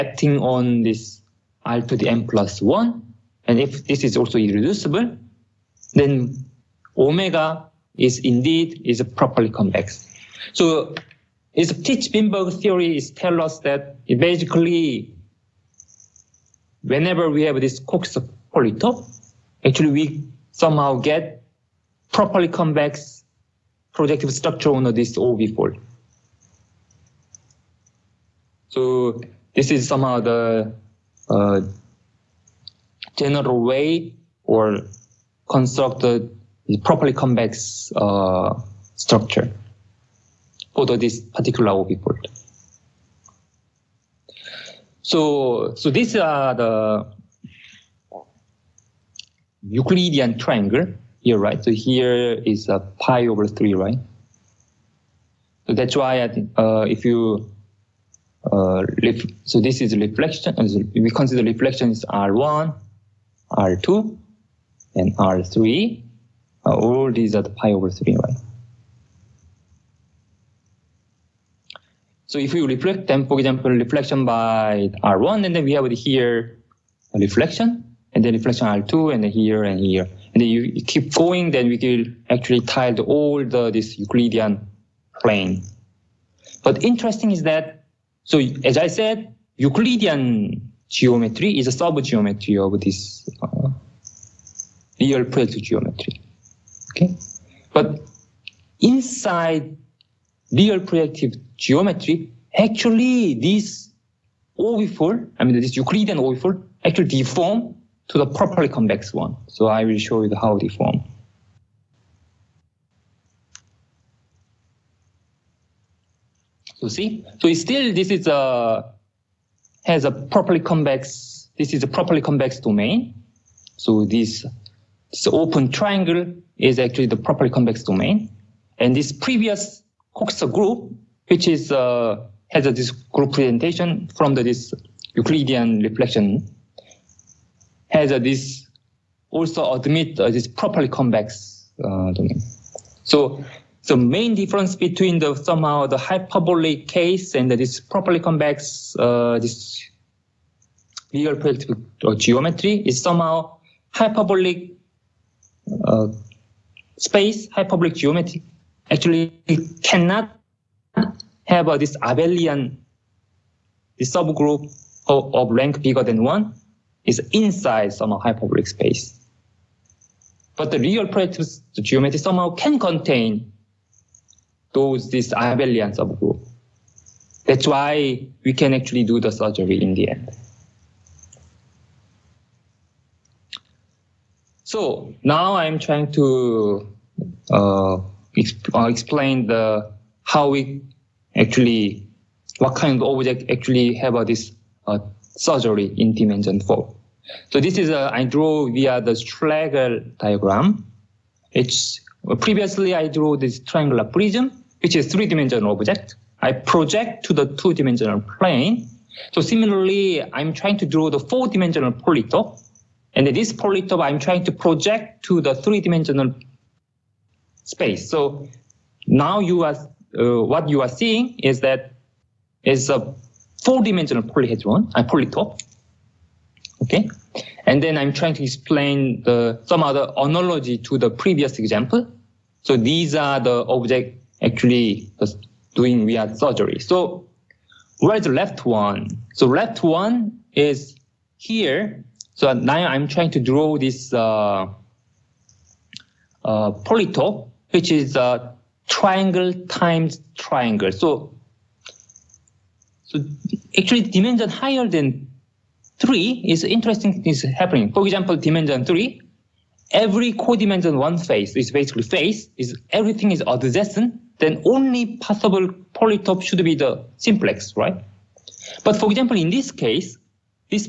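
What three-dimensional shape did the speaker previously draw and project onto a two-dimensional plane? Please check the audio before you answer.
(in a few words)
Triangular prism.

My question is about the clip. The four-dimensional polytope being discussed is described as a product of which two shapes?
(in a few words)
Triangle times triangle.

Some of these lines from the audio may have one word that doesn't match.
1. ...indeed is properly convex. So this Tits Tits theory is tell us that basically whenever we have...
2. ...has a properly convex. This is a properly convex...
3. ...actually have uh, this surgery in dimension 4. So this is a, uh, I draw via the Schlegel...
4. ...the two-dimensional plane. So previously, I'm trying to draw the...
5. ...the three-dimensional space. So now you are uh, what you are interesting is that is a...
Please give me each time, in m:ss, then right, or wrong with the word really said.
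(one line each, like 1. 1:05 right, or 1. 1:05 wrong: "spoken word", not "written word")
1. 0:08 wrong: "Vinberg", not "Tits"
2. 1:59 right
3. 3:13 right
4. 3:27 wrong: "similarly", not "previously"
5. 3:35 wrong: "seeing", not "interesting".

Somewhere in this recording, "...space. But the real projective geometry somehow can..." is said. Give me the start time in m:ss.
2:48.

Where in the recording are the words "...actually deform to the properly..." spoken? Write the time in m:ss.
1:46.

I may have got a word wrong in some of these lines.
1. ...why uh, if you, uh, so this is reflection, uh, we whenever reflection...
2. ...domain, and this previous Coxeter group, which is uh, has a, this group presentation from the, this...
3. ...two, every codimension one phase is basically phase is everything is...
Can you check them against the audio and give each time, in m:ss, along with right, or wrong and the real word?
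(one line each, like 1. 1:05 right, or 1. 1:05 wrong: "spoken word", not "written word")
1. 0:55 wrong: "consider", not "whenever"
2. 2:07 right
3. 4:18 wrong: "three", not "two".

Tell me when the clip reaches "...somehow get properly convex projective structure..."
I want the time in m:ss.
0:20.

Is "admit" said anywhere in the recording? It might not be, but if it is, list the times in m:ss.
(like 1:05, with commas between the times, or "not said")
2:19.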